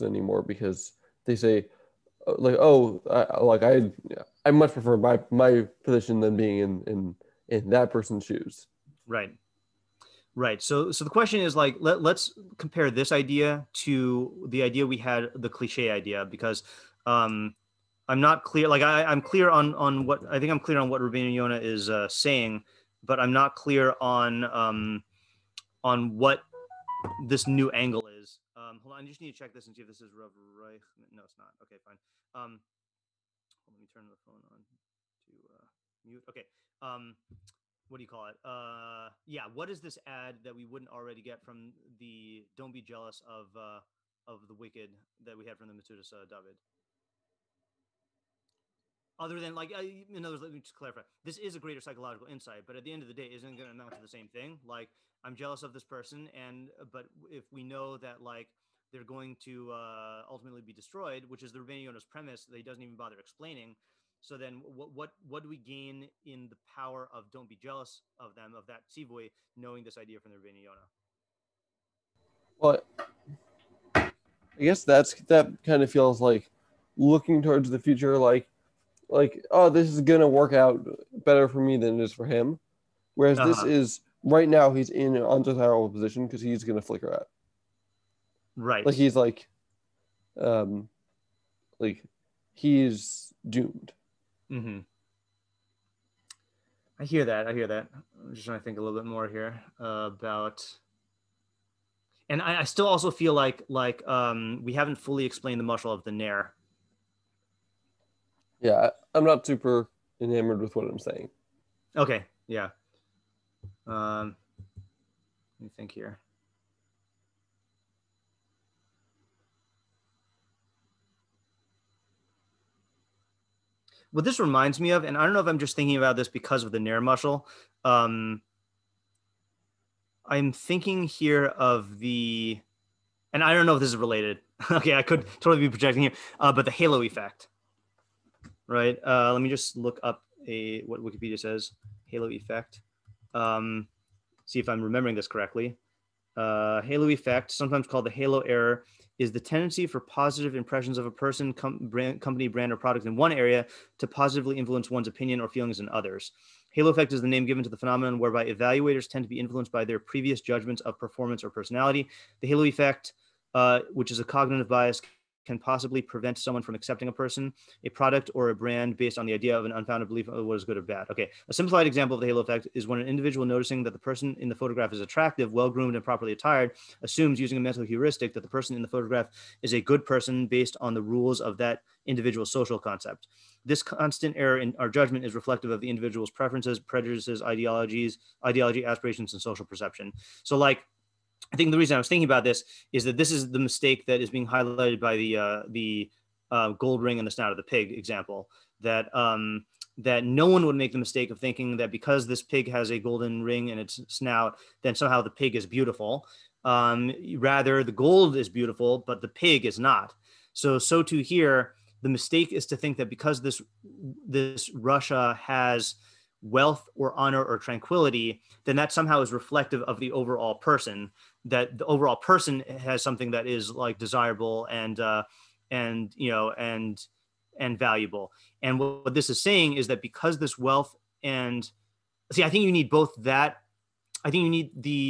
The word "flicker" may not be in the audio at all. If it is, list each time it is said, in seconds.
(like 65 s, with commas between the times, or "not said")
86 s.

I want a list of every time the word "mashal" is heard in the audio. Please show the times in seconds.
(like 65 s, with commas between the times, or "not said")
105 s, 127 s.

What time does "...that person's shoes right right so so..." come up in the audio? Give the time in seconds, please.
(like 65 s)
7 s.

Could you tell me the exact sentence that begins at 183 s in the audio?
This constant error in our judgment is reflective of the individual's preferences, prejudices, ideologies, ideology, aspirations, and social perception.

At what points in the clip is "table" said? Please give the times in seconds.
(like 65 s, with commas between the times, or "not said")
not said.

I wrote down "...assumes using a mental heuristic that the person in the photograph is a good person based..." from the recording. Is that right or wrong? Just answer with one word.
right.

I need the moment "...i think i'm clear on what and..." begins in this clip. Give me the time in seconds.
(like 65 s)
20 s.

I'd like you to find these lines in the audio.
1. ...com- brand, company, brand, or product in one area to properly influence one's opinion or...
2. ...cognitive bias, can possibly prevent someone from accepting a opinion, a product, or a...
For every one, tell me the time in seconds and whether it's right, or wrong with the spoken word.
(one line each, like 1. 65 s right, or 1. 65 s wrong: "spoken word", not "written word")
1. 151 s wrong: "positively", not "properly"
2. 164 s wrong: "person", not "opinion".